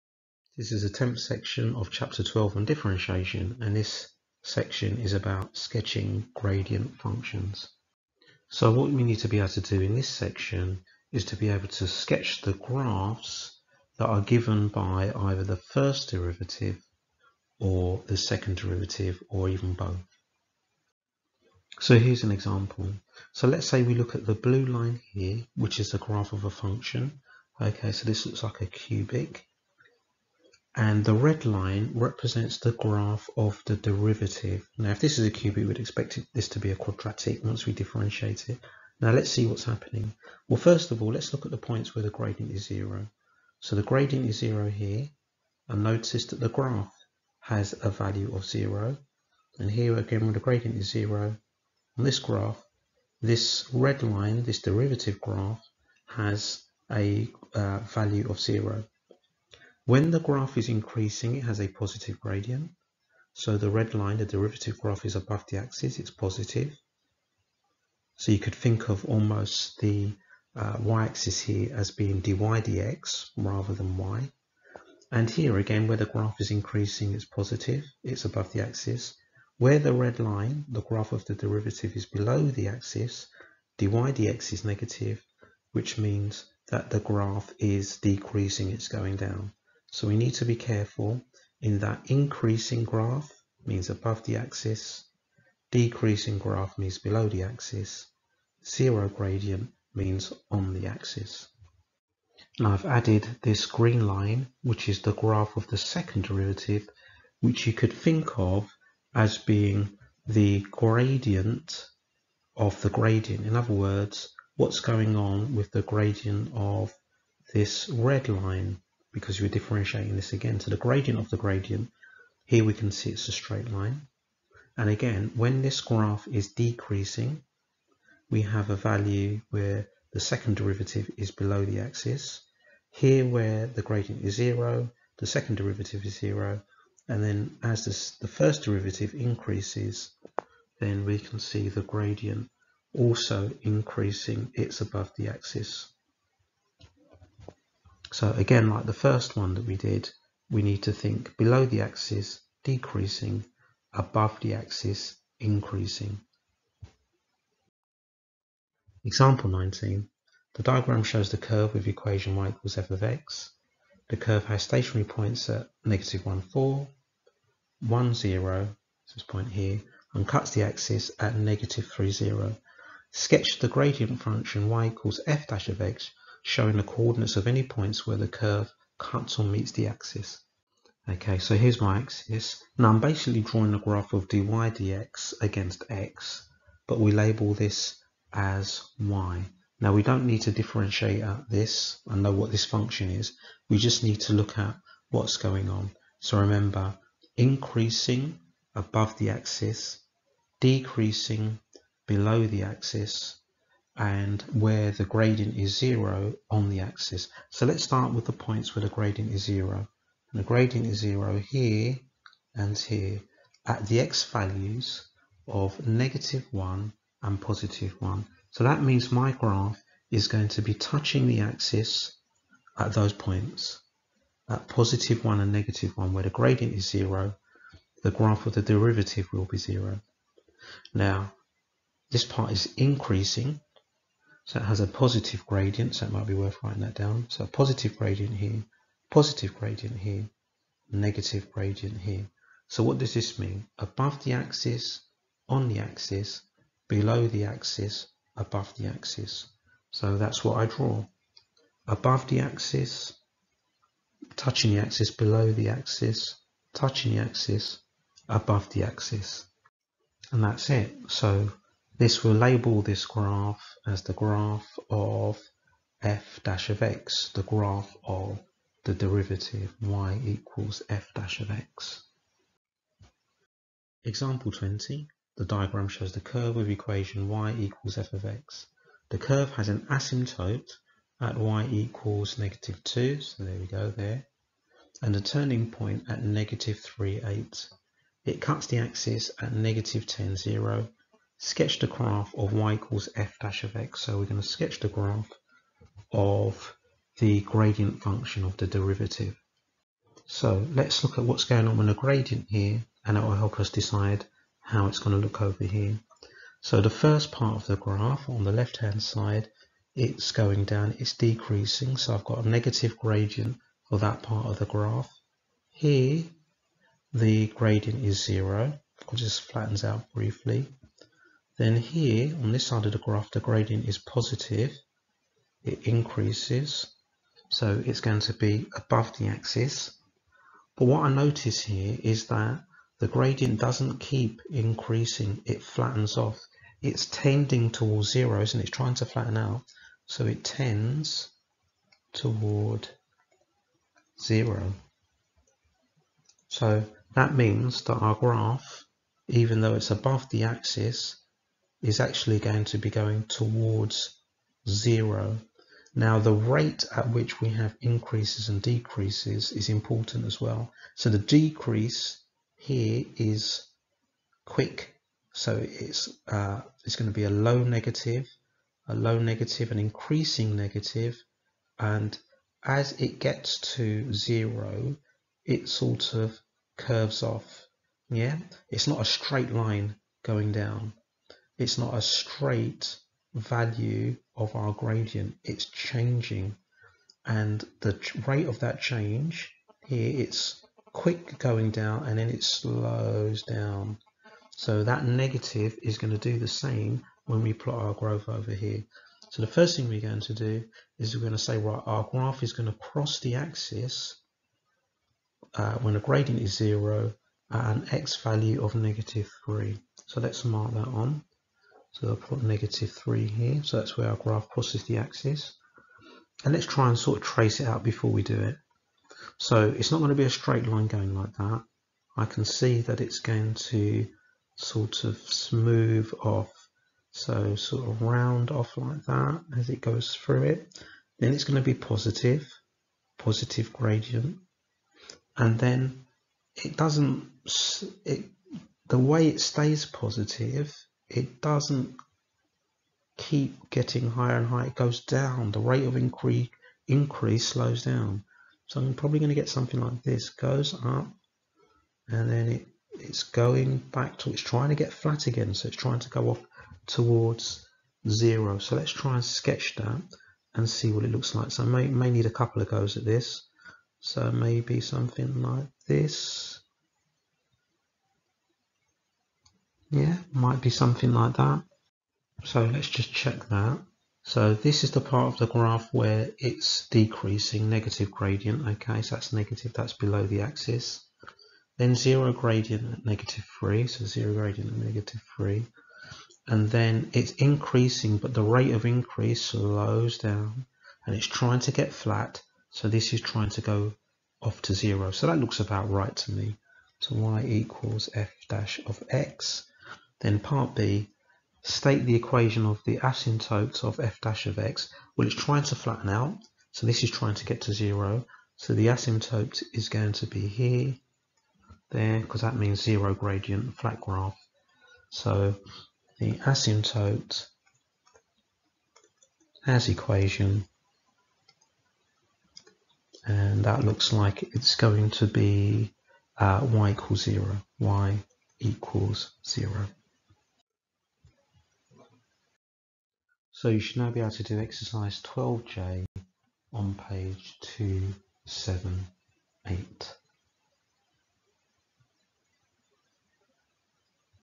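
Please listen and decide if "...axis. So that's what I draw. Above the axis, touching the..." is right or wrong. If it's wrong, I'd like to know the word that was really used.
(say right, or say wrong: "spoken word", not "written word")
right.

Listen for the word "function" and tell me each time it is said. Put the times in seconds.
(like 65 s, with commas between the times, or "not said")
6 s, 26 s, 174 s, 192 s, 298 s.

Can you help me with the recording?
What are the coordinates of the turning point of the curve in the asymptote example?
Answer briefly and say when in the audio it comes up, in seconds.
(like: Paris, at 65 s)
(-3, 8), at 286 s.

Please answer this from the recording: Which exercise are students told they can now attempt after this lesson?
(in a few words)
Exercise 12J.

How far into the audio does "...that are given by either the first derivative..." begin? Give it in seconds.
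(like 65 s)
13 s.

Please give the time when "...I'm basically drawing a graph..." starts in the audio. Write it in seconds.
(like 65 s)
182 s.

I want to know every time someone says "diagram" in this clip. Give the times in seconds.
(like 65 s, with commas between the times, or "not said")
160 s, 275 s.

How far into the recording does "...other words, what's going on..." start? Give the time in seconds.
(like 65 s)
113 s.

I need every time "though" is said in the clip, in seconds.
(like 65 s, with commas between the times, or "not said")
349 s.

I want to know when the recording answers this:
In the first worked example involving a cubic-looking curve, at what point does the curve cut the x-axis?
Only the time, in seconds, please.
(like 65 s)
171 s.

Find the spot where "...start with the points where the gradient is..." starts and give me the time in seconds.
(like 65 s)
207 s.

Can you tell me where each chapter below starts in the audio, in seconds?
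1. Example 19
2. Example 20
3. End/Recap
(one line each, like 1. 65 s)
1. 157 s
2. 273 s
3. 532 s.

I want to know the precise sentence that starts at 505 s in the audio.
Well, it's trying to flatten out, so this is trying to get to zero.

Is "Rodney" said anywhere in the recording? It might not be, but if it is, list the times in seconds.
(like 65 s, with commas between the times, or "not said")
not said.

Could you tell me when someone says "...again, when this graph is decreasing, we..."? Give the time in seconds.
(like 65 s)
124 s.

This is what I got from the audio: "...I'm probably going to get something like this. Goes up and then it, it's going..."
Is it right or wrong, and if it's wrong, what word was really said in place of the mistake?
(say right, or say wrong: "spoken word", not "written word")
right.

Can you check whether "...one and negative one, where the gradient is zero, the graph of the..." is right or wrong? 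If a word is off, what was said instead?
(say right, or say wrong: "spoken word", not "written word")
right.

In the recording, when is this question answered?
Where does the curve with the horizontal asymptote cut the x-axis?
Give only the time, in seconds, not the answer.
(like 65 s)
289 s.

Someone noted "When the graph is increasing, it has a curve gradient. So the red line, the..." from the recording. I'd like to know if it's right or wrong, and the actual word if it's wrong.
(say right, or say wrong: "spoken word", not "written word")
wrong: "positive", not "curve".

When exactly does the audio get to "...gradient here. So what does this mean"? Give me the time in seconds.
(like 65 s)
241 s.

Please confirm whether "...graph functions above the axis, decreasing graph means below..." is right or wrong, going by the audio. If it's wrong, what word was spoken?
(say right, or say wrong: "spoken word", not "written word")
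wrong: "means", not "functions".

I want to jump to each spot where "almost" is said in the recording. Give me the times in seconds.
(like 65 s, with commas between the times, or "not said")
69 s.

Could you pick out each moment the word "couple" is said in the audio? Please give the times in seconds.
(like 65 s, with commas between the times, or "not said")
462 s.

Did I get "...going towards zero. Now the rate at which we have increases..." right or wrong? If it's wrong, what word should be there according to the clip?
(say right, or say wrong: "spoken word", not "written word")
right.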